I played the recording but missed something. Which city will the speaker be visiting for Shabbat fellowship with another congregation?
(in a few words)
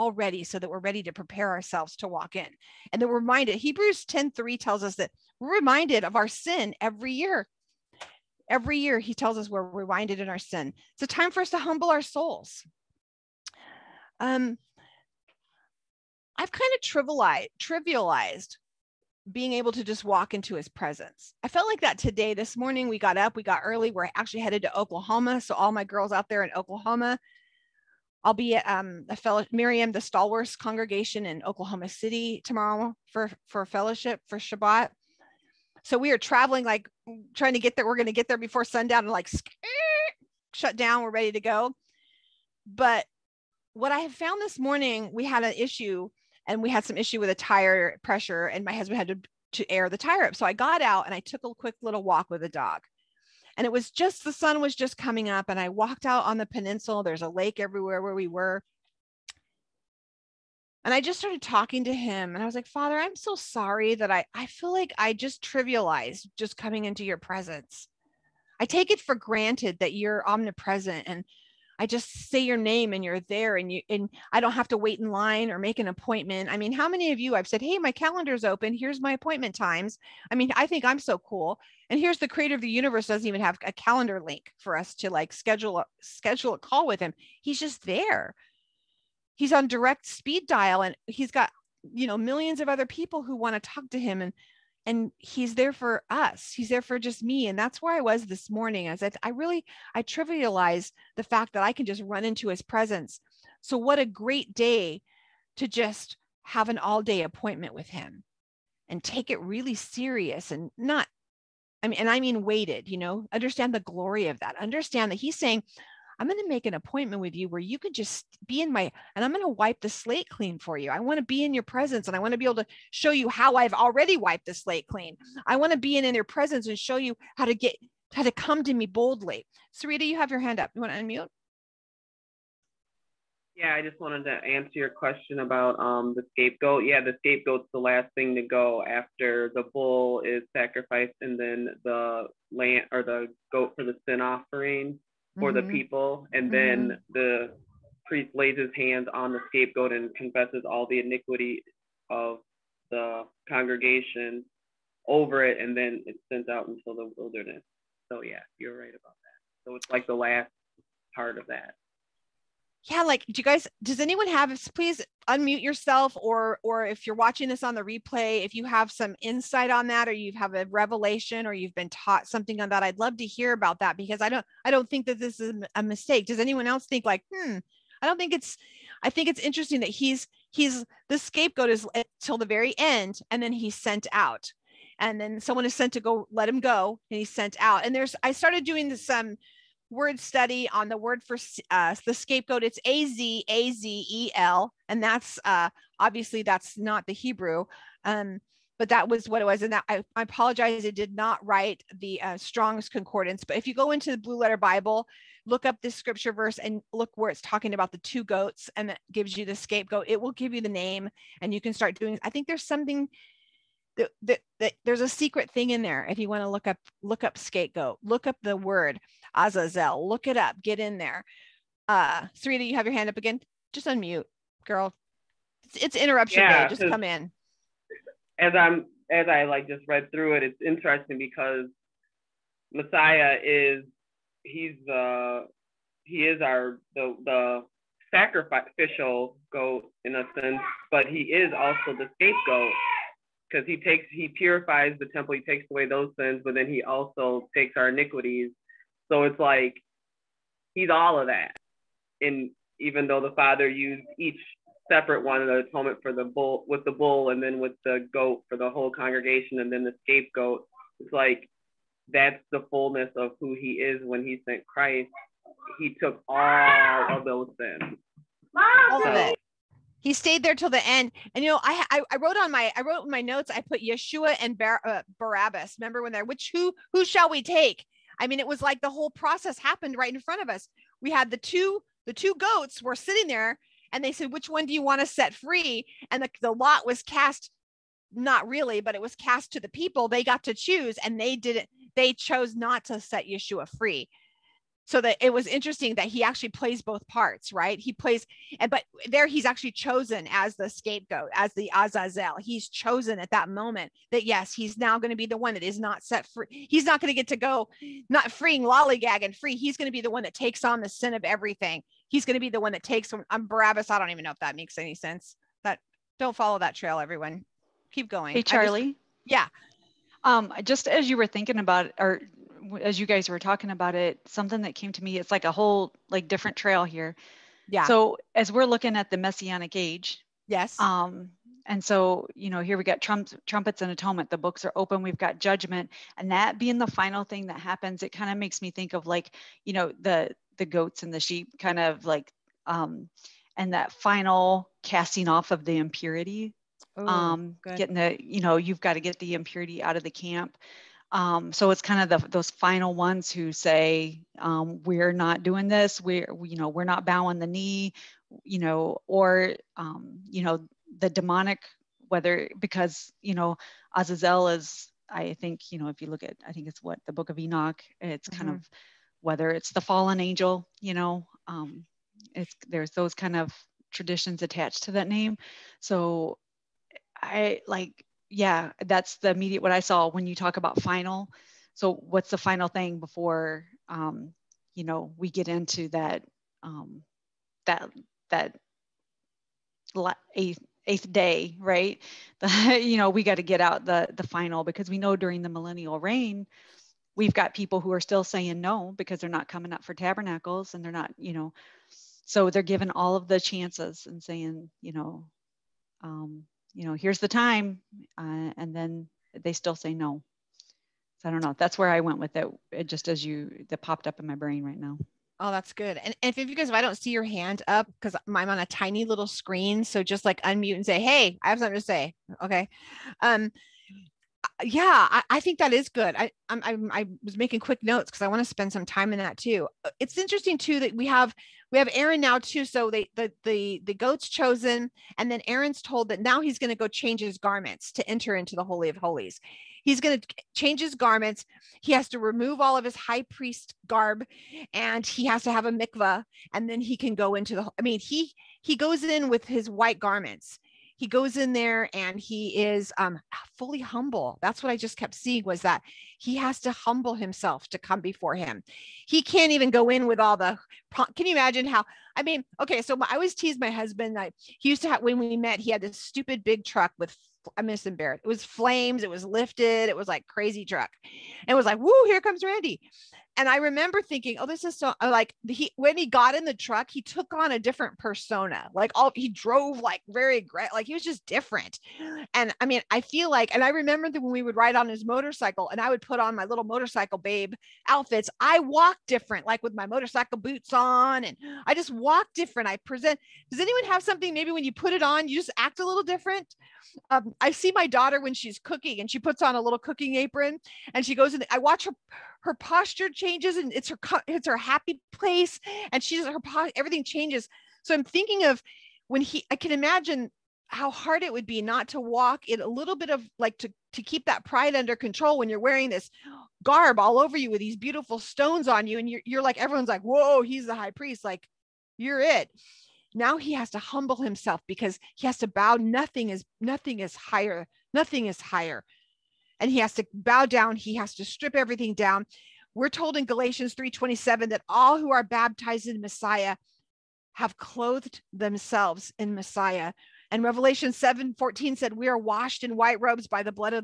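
Oklahoma City.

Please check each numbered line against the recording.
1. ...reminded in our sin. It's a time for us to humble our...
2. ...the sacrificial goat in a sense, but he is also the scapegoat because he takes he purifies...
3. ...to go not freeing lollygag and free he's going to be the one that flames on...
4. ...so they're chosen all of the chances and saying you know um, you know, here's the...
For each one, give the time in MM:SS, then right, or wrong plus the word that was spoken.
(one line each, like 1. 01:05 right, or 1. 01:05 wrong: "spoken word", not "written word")
1. 00:09 right
2. 03:57 right
3. 05:07 wrong: "takes", not "flames"
4. 06:42 wrong: "given", not "chosen".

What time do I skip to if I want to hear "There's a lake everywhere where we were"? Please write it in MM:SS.
00:57.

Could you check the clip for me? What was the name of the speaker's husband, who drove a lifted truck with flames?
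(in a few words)
Randy.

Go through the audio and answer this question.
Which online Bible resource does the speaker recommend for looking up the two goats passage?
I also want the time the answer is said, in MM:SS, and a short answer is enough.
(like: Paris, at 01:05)
Blue Letter Bible, at 03:24.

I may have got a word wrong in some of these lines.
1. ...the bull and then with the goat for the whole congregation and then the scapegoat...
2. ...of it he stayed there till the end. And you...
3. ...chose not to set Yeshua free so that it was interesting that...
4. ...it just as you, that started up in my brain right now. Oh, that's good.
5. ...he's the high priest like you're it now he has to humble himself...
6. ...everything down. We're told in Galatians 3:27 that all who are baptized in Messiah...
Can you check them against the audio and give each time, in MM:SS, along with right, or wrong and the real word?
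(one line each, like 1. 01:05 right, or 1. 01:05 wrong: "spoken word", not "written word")
1. 04:16 right
2. 04:29 right
3. 04:52 right
4. 06:52 wrong: "popped", not "started"
5. 08:40 right
6. 08:51 right.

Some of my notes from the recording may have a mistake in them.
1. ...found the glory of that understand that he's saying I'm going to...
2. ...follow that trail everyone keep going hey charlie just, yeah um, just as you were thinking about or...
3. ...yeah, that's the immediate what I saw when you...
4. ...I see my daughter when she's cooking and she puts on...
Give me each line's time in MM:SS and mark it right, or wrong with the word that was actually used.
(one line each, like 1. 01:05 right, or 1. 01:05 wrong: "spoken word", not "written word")
1. 01:53 wrong: "understand", not "found"
2. 05:16 right
3. 06:18 right
4. 08:17 right.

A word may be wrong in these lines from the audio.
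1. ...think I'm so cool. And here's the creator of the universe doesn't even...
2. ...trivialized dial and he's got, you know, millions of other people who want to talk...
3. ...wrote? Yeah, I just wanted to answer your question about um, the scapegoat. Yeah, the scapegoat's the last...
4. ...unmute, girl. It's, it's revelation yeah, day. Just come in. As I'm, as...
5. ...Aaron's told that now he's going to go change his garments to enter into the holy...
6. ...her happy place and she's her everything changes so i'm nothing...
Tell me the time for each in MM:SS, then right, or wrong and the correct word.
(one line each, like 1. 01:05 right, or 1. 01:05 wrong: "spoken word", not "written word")
1. 01:20 right
2. 01:30 wrong: "speed", not "trivialized"
3. 02:10 wrong: "unmute", not "wrote"
4. 03:43 wrong: "interruption", not "revelation"
5. 07:15 right
6. 08:24 wrong: "thinking", not "nothing".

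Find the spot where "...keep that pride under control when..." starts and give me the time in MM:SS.
08:34.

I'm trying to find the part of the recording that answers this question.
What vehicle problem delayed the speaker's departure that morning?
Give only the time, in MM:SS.
00:47.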